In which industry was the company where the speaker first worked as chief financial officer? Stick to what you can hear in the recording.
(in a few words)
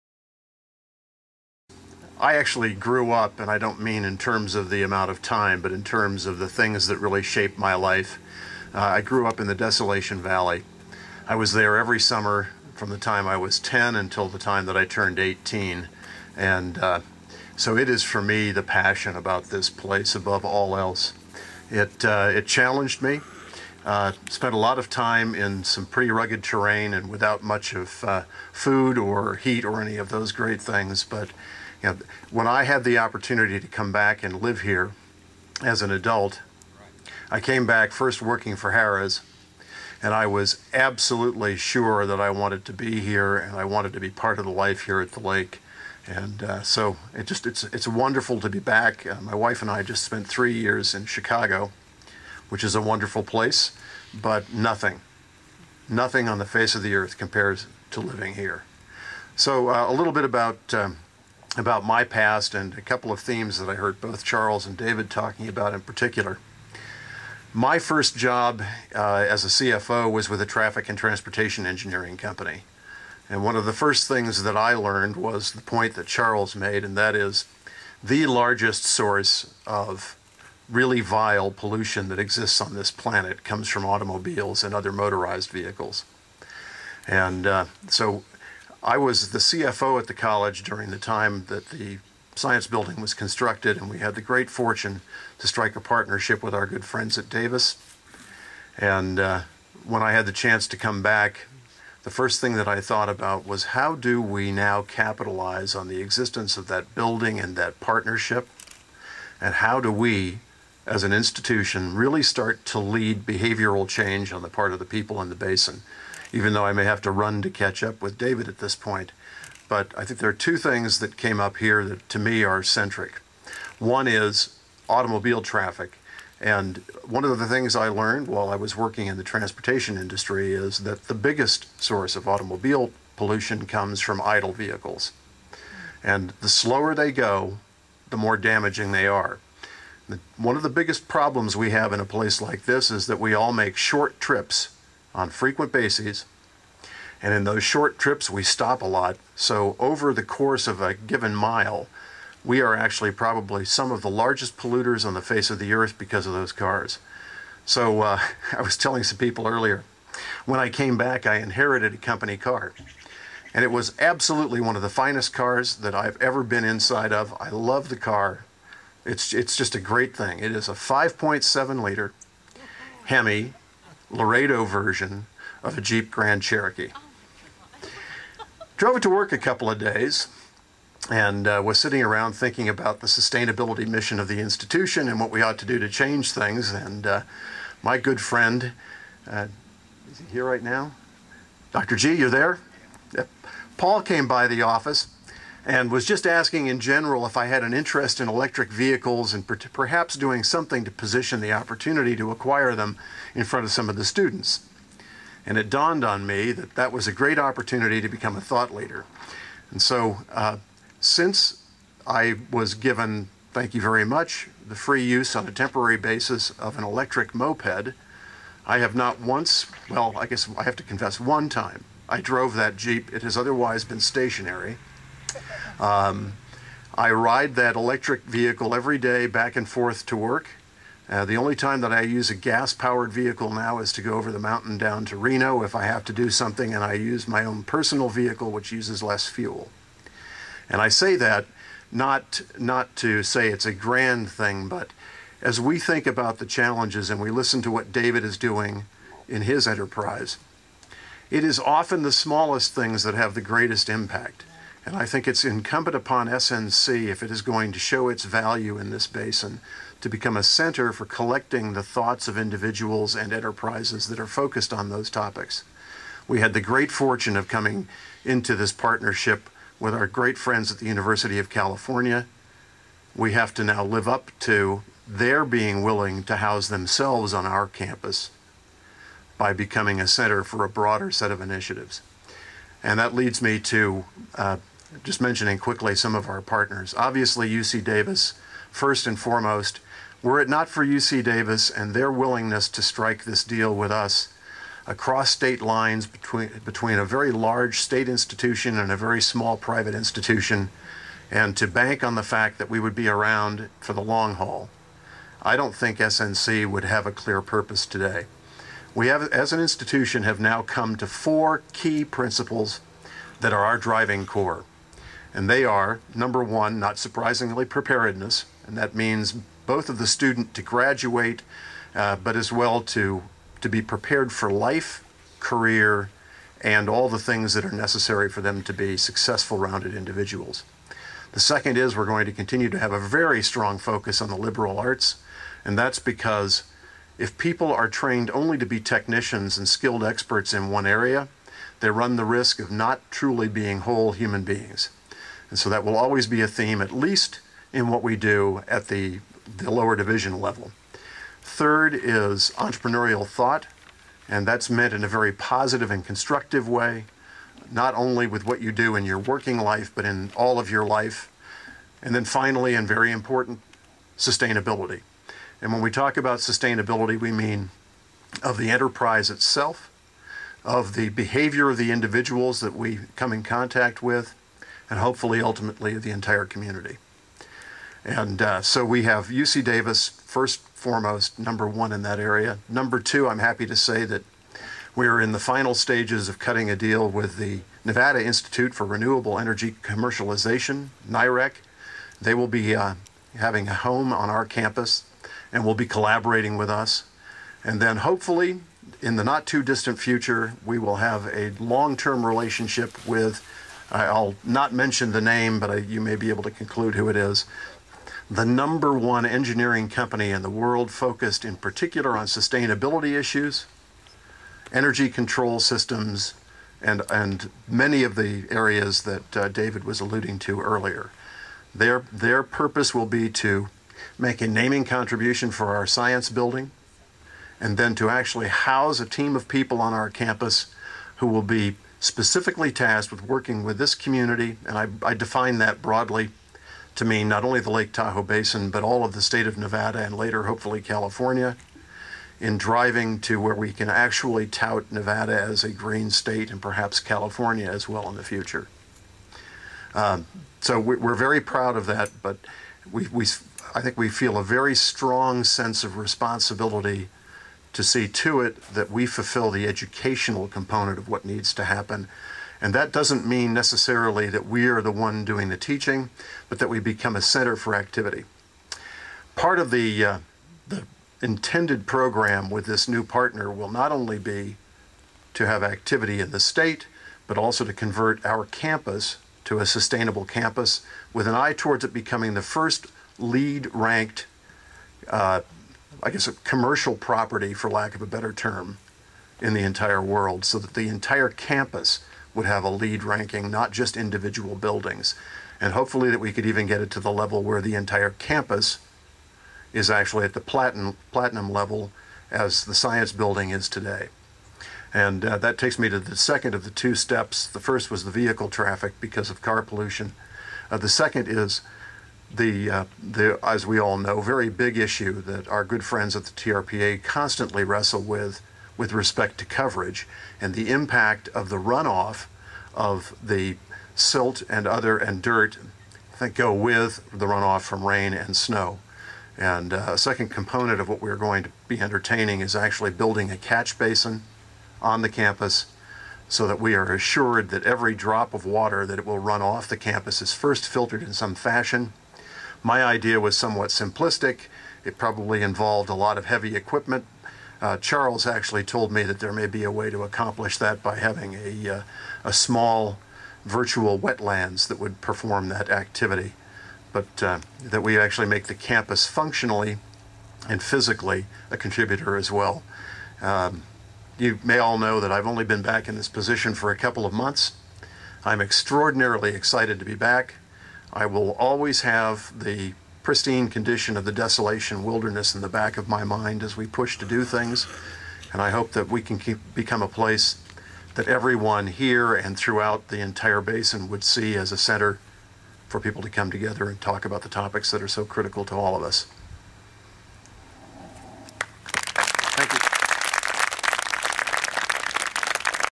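traffic and transportation engineering.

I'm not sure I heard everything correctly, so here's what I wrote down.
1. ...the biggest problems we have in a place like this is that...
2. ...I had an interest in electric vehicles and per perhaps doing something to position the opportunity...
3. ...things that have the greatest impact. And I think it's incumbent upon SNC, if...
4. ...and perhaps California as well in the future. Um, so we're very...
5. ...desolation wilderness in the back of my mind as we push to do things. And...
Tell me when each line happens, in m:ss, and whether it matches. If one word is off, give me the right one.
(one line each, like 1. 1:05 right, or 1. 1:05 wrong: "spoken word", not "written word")
1. 2:20 right
2. 3:17 right
3. 4:12 right
4. 7:26 right
5. 9:34 right.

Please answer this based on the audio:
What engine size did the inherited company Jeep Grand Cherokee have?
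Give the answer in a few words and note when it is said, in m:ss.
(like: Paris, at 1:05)
5.7 liter, at 2:50.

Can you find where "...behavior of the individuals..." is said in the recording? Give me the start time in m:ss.
6:11.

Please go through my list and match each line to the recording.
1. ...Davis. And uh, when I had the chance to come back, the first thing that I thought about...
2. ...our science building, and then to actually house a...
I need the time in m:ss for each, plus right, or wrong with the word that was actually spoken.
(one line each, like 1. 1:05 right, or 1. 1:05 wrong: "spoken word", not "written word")
1. 1:37 right
2. 7:05 right.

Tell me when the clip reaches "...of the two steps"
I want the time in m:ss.
8:26.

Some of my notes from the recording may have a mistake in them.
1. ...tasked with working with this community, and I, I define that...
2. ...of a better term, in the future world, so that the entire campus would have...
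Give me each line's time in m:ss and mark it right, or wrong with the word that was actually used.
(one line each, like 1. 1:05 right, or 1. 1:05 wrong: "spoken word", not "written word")
1. 7:12 right
2. 8:07 wrong: "entire", not "future".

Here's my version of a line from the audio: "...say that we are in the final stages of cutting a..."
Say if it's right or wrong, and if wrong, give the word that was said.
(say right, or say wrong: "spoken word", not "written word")
right.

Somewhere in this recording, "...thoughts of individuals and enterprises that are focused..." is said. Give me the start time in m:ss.
4:21.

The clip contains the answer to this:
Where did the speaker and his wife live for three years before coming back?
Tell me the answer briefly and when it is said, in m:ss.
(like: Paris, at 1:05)
Chicago, at 0:51.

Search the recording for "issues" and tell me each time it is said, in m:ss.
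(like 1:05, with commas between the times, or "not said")
6:53, 8:34.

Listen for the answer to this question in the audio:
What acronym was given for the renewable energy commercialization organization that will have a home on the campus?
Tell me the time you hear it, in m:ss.
6:31.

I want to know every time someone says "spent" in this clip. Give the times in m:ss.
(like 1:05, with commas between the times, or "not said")
0:24, 0:50.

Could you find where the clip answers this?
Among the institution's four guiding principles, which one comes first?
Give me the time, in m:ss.
5:17.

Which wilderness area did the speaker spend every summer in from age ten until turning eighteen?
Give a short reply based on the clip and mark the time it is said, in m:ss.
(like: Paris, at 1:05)
Desolation Valley, at 0:09.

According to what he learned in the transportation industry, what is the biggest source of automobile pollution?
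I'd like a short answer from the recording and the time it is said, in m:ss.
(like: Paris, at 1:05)
idle vehicles, at 2:14.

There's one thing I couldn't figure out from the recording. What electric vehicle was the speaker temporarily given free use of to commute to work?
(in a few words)
electric moped.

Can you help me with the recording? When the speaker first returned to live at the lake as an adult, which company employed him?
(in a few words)
Harrah's.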